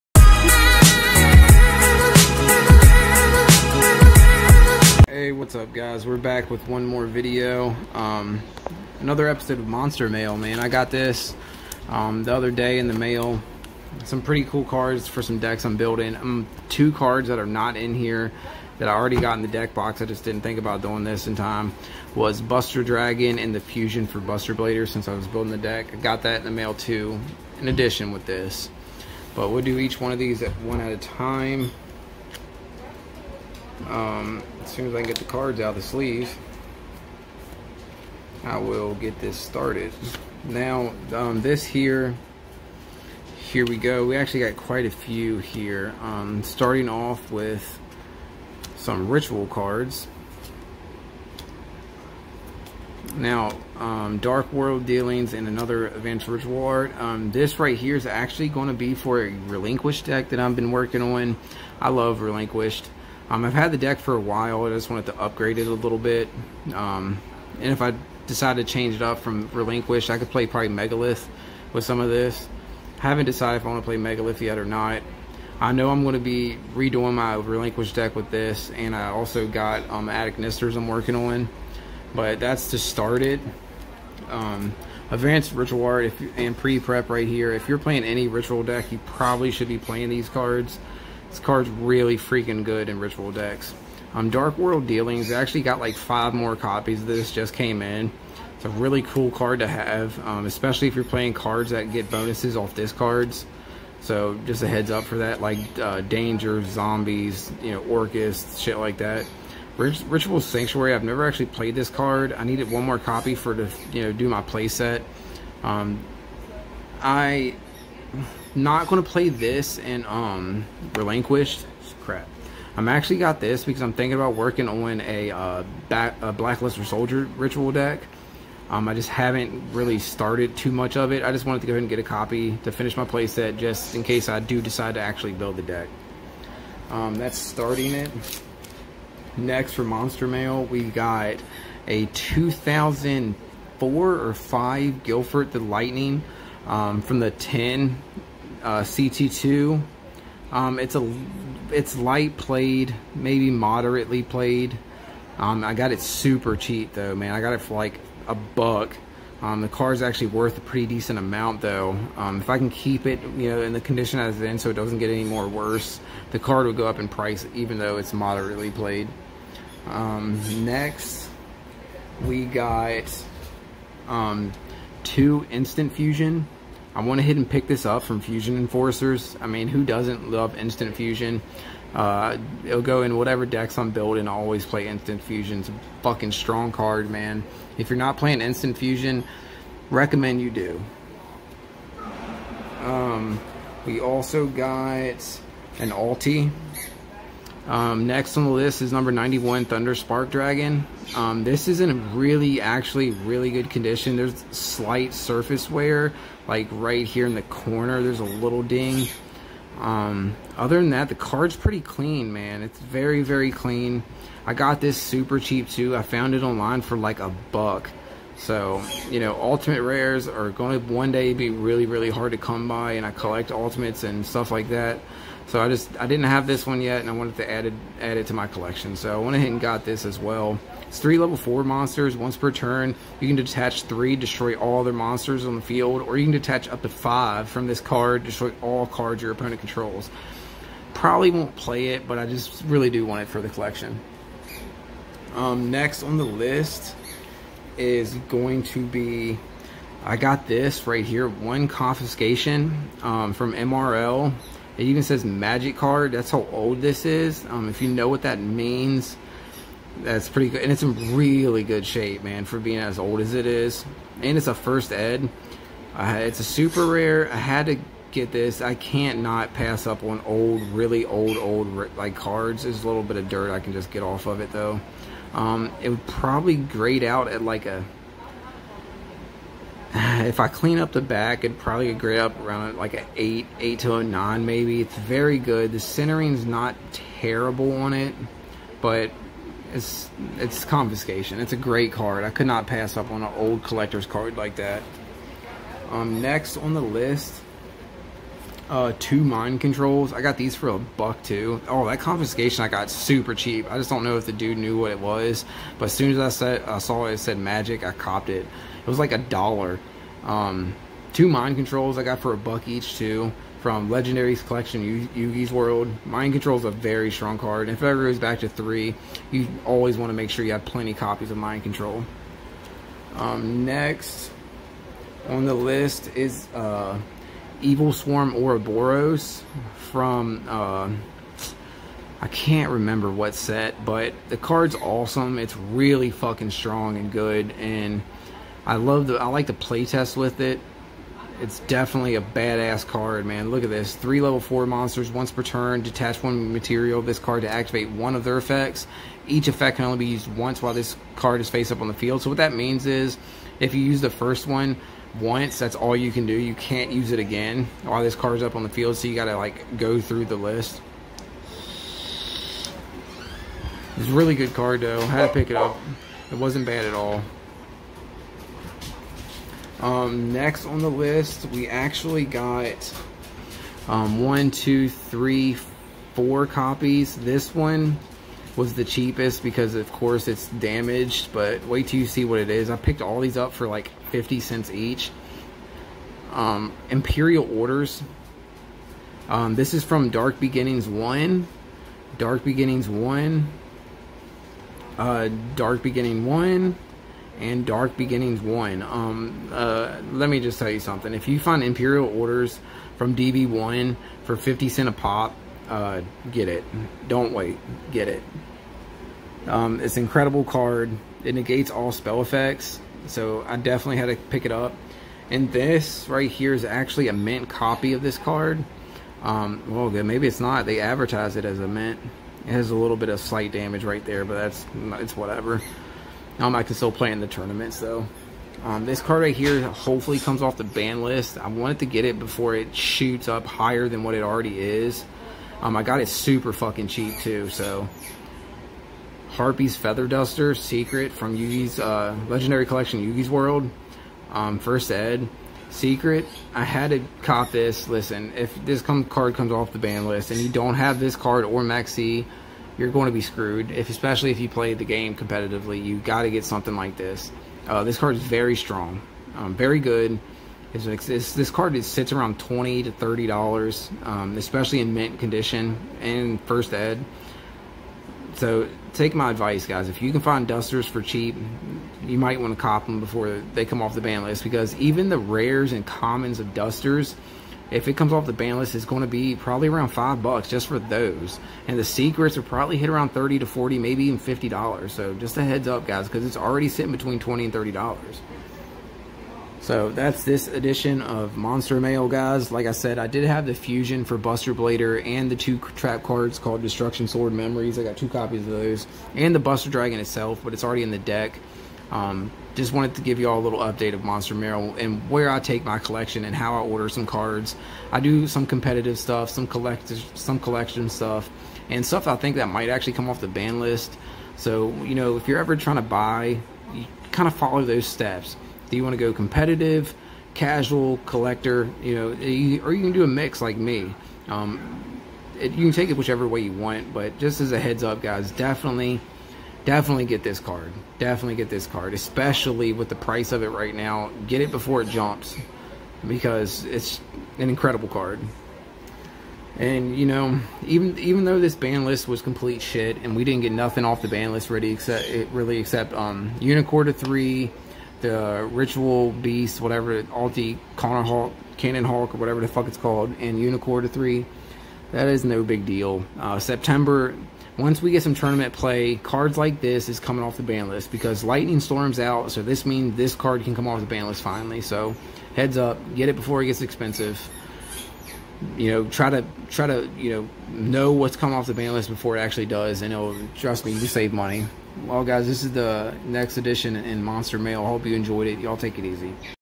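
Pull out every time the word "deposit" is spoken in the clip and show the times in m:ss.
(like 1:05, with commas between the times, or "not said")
not said.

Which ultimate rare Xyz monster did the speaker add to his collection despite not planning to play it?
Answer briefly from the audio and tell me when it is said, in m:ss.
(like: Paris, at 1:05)
Number 91 Thunder Spark Dragon, at 3:18.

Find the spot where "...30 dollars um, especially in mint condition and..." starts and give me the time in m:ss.
7:42.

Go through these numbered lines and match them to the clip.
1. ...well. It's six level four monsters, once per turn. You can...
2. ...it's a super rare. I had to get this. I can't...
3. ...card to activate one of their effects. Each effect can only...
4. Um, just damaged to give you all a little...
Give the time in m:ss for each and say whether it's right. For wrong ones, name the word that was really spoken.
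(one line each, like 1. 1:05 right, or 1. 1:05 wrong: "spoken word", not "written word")
1. 3:50 wrong: "three", not "six"
2. 4:26 right
3. 5:47 right
4. 8:21 wrong: "wanted", not "damaged".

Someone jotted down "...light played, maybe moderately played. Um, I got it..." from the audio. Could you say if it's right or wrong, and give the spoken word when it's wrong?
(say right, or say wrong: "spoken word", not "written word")
right.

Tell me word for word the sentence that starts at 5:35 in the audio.
It's really fucking strong and good, and I love the, I like the playtest with it.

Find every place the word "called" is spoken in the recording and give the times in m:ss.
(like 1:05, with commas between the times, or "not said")
8:16, 9:12.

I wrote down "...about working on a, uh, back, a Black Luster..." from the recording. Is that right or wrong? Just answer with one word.
right.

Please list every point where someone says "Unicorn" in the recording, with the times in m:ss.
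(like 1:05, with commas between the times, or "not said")
9:06, 9:13.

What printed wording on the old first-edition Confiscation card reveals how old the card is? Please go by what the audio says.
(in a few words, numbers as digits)
magic card.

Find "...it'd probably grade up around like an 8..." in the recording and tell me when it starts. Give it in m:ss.
4:41.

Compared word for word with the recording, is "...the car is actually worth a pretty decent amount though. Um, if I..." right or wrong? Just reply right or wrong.
right.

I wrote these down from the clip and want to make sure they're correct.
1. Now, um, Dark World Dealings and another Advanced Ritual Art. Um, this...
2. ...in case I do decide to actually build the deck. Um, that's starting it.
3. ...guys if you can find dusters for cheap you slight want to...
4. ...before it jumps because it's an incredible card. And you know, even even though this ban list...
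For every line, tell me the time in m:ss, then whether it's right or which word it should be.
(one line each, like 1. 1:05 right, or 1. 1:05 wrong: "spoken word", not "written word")
1. 0:53 right
2. 2:13 right
3. 7:49 wrong: "might", not "slight"
4. 8:54 right.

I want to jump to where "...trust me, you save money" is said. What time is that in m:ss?
9:33.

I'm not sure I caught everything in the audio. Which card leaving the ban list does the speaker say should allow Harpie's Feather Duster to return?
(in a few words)
Lightning Storm.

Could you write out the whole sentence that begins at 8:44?
Um, it, you can take it whichever way you want, but just as a heads up, guys, definitely, definitely get this card.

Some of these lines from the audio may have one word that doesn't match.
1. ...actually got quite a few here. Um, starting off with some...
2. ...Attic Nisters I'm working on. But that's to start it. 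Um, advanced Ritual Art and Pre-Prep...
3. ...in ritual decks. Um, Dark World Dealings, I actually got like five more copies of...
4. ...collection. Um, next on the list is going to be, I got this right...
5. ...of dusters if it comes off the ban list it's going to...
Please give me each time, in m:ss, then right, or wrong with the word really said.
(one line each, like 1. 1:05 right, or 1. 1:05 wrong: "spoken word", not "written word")
1. 0:44 right
2. 1:20 right
3. 1:32 right
4. 4:03 right
5. 7:56 right.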